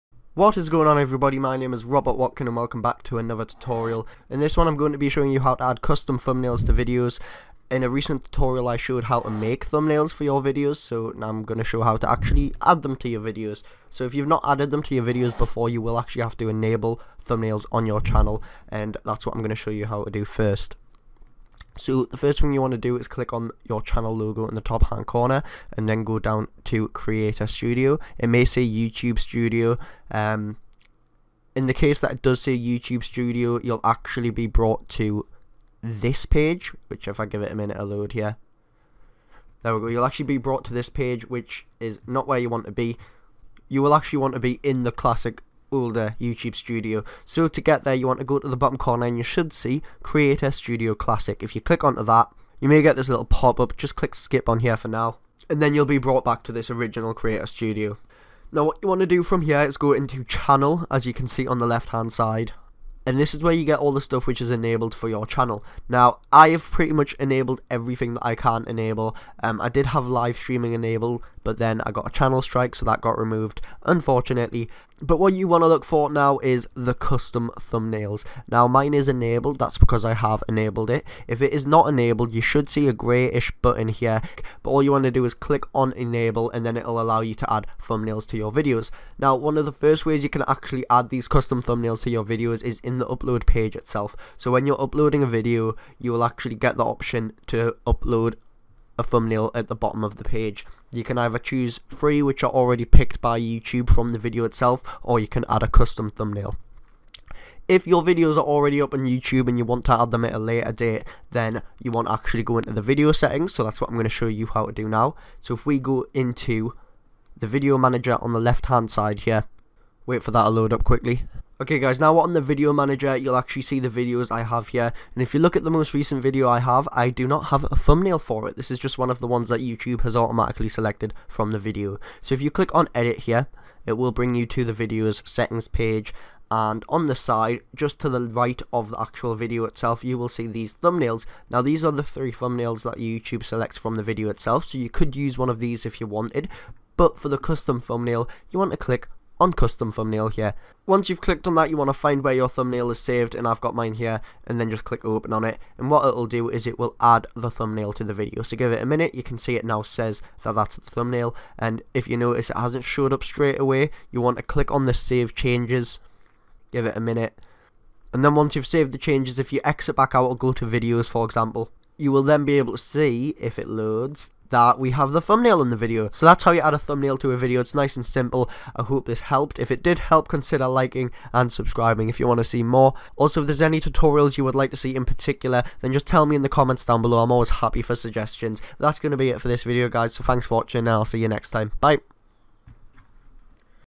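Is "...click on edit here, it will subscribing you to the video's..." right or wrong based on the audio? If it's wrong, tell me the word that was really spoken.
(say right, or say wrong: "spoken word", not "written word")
wrong: "bring", not "subscribing".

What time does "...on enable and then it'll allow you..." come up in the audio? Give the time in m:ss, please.
1:25.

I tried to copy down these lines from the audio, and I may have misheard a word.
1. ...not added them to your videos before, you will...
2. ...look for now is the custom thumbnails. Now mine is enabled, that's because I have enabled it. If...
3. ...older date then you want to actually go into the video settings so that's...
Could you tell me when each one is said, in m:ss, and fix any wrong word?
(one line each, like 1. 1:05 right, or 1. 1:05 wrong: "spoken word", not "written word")
1. 0:14 right
2. 1:15 right
3. 1:50 wrong: "later", not "older".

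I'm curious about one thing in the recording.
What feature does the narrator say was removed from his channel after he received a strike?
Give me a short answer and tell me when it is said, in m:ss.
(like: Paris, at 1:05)
Live streaming, at 1:10.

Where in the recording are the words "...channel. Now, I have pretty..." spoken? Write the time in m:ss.
1:05.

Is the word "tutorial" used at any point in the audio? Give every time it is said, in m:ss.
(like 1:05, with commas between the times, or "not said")
0:03, 0:08, 3:03.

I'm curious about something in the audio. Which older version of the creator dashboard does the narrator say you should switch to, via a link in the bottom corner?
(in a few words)
Creator Studio Classic.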